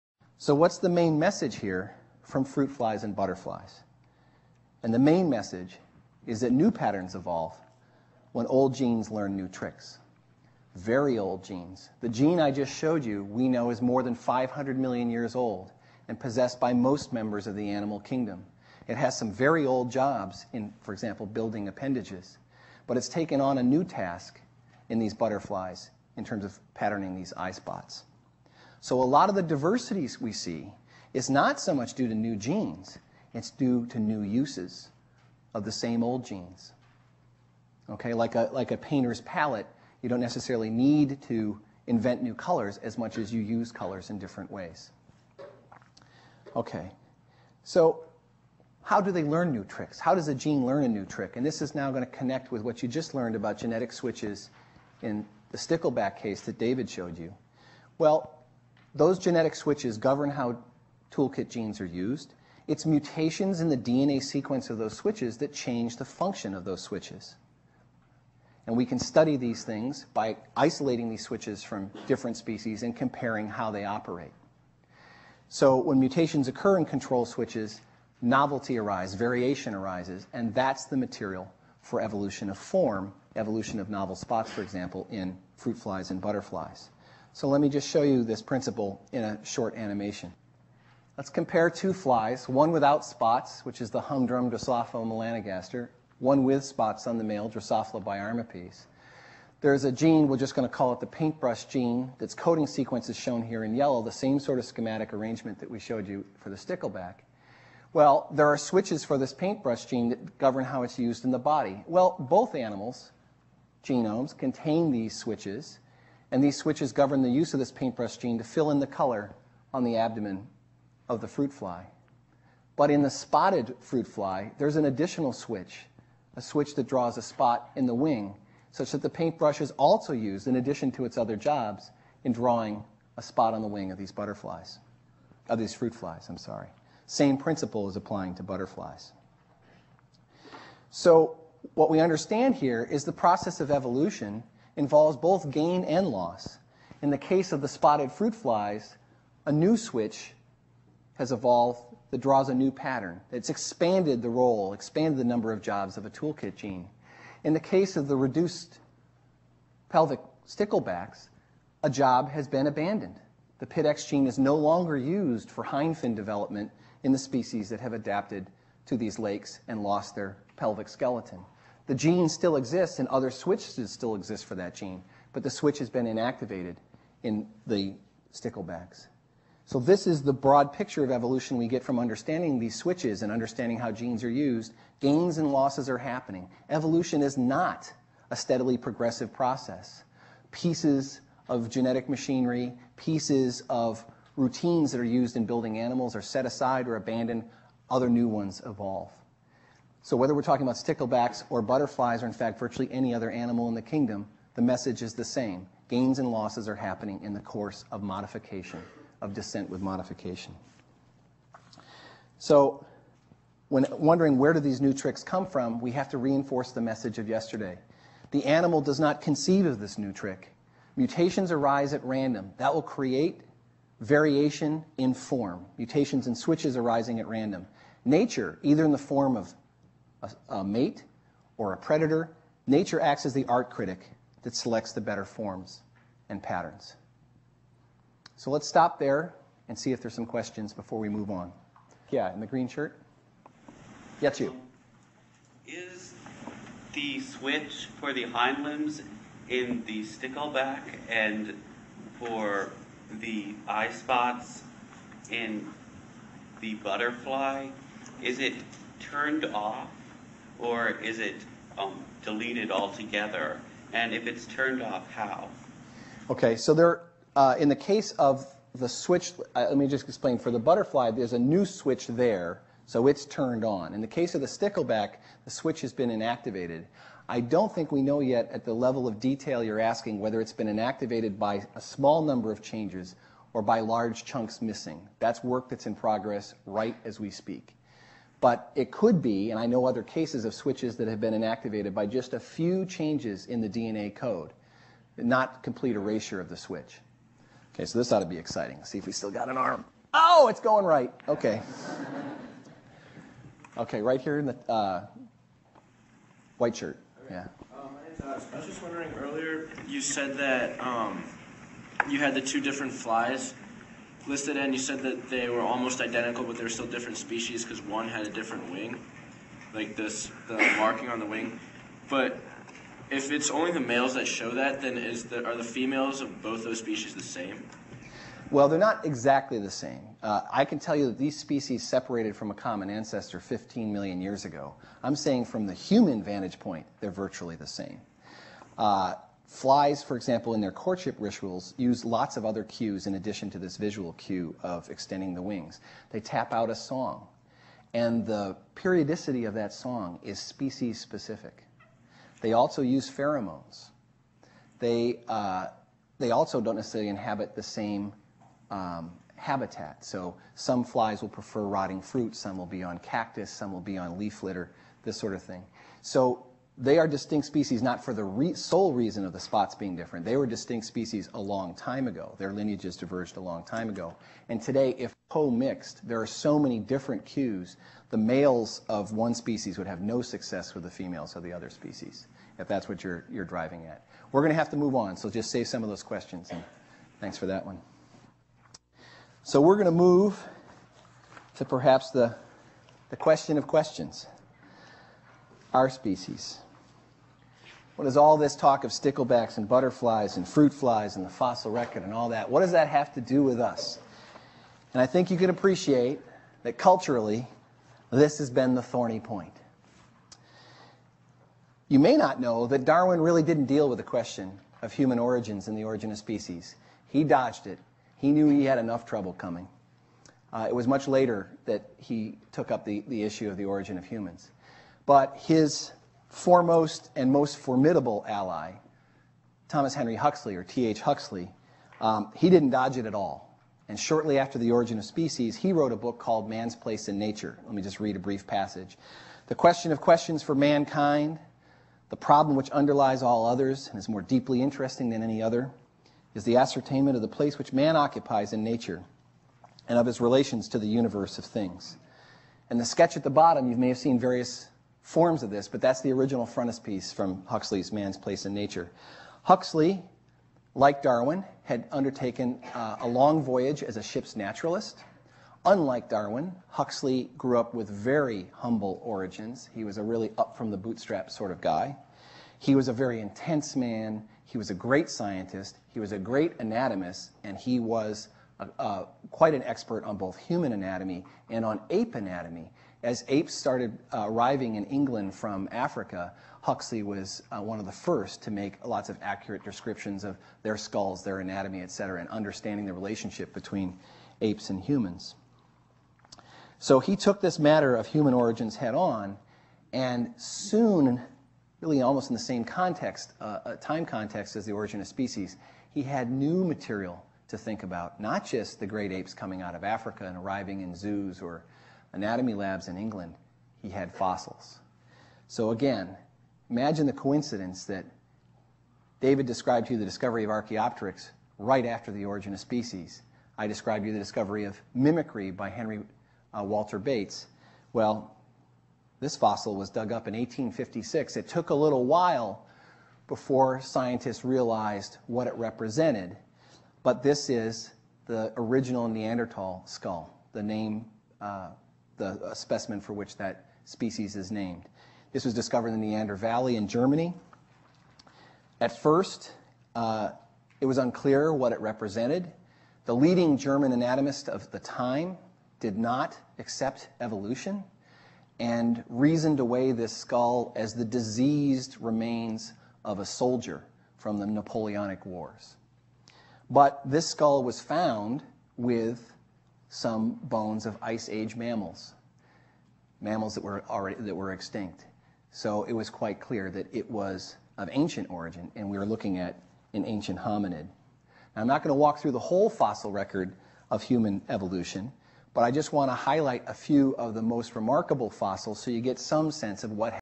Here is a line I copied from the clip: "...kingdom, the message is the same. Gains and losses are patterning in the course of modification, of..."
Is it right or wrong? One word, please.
wrong.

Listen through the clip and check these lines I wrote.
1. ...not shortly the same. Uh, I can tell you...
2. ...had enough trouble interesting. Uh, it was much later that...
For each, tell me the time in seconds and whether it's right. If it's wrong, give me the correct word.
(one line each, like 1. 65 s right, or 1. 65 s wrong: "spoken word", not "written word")
1. 328 s wrong: "exactly", not "shortly"
2. 418 s wrong: "coming", not "interesting".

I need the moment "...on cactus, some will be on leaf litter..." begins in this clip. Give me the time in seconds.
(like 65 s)
362 s.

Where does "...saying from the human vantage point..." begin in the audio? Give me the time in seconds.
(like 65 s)
335 s.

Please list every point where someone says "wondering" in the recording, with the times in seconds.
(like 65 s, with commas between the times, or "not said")
213 s, 308 s.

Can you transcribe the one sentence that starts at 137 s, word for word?
Same principle is applying to butterflies.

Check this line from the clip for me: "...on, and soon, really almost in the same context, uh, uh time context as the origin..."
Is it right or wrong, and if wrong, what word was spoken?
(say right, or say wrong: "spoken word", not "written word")
right.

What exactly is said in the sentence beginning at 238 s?
So let's stop there and see if there's some questions before we move on.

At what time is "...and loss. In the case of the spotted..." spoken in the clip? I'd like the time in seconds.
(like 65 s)
145 s.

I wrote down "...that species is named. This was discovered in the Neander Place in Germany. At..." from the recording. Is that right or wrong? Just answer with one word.
wrong.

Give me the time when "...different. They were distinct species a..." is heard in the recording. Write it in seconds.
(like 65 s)
369 s.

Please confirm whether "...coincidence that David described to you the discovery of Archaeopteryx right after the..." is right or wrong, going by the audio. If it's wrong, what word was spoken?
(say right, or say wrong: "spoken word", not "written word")
right.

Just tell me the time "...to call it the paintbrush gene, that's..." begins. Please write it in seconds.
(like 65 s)
100 s.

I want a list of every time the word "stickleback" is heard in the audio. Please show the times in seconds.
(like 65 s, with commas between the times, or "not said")
55 s, 106 s, 160 s, 178 s, 200 s, 250 s, 274 s, 398 s.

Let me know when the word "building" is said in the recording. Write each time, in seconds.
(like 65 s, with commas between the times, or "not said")
21 s, 195 s.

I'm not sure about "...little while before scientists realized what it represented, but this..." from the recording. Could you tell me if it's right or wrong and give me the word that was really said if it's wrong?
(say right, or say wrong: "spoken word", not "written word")
right.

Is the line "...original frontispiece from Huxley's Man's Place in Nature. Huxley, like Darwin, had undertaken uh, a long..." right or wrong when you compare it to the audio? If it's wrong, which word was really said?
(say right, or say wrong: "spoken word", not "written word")
right.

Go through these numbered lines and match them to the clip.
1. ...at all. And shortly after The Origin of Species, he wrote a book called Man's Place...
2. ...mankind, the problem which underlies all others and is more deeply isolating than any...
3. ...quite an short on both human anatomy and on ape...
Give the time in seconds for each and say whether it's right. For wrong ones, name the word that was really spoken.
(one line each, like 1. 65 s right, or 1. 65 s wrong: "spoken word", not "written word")
1. 433 s right
2. 440 s wrong: "interesting", not "isolating"
3. 479 s wrong: "expert", not "short".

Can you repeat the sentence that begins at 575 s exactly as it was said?
So it was quite clear that it was of ancient origin, and we were looking at an ancient hominid.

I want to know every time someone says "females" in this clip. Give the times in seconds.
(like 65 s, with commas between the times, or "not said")
325 s, 380 s.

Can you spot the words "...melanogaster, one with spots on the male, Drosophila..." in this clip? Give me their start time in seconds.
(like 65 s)
95 s.